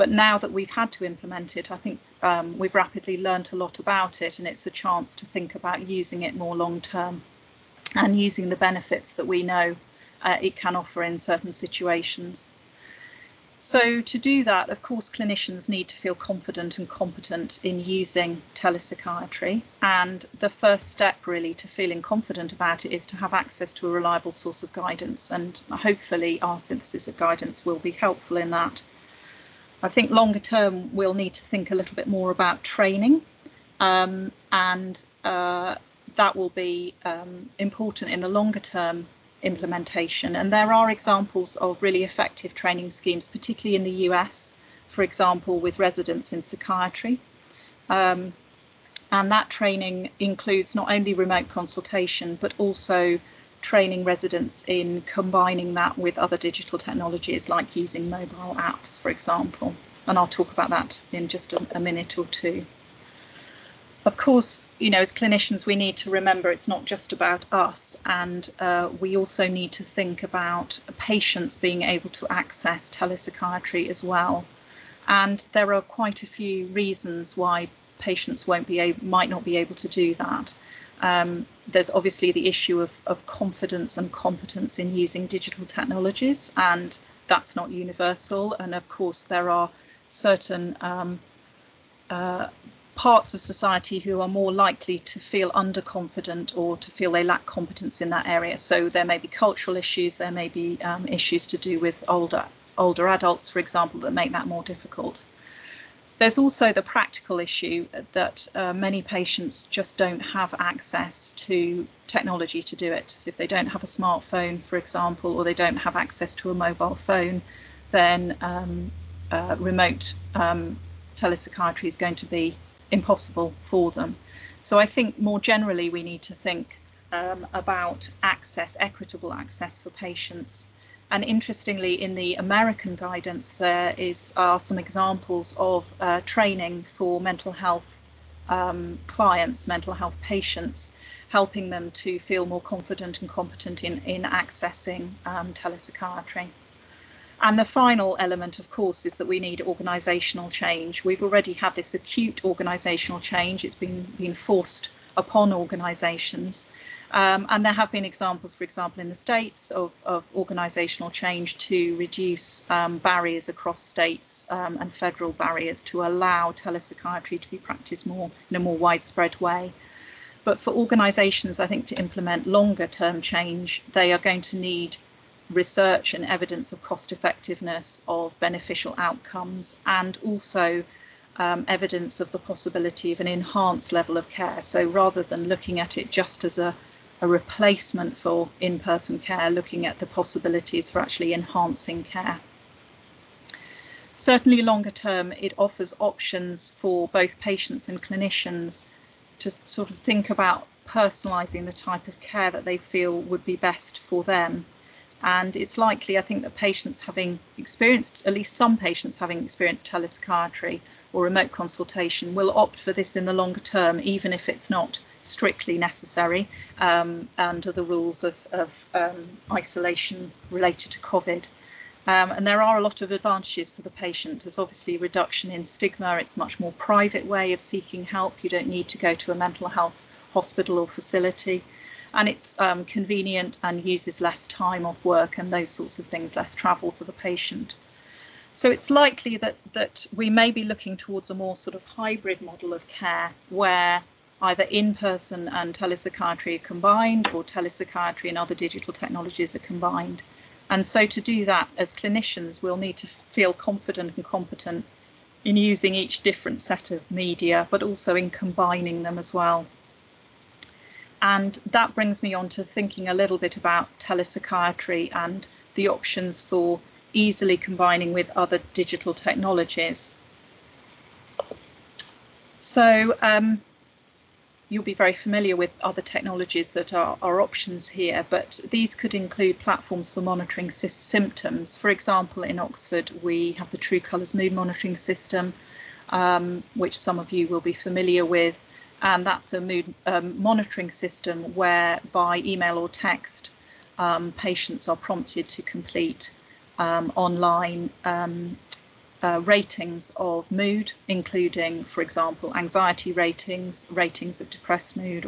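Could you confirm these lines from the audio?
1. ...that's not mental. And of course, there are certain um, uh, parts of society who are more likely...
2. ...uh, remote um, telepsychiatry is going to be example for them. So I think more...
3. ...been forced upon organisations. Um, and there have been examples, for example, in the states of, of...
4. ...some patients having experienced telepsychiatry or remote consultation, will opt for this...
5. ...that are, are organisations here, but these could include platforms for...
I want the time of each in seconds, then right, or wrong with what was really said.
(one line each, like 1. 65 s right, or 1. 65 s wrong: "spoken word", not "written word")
1. 87 s wrong: "universal", not "mental"
2. 119 s wrong: "impossible", not "example"
3. 154 s right
4. 208 s right
5. 276 s wrong: "options", not "organisations".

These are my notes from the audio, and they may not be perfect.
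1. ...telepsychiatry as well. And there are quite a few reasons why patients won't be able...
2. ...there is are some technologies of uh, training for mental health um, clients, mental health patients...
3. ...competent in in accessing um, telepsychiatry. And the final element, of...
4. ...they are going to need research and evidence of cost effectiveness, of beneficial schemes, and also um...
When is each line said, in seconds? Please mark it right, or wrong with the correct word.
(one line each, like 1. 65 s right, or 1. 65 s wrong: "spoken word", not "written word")
1. 72 s right
2. 133 s wrong: "examples", not "technologies"
3. 143 s right
4. 173 s wrong: "outcomes", not "schemes".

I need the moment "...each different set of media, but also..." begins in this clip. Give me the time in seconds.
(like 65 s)
255 s.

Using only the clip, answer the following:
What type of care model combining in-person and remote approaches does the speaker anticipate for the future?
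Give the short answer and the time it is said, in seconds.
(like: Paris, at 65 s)
Hybrid model, at 241 s.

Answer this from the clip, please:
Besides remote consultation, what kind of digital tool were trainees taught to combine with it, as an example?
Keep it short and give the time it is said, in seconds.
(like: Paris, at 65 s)
Mobile apps, at 58 s.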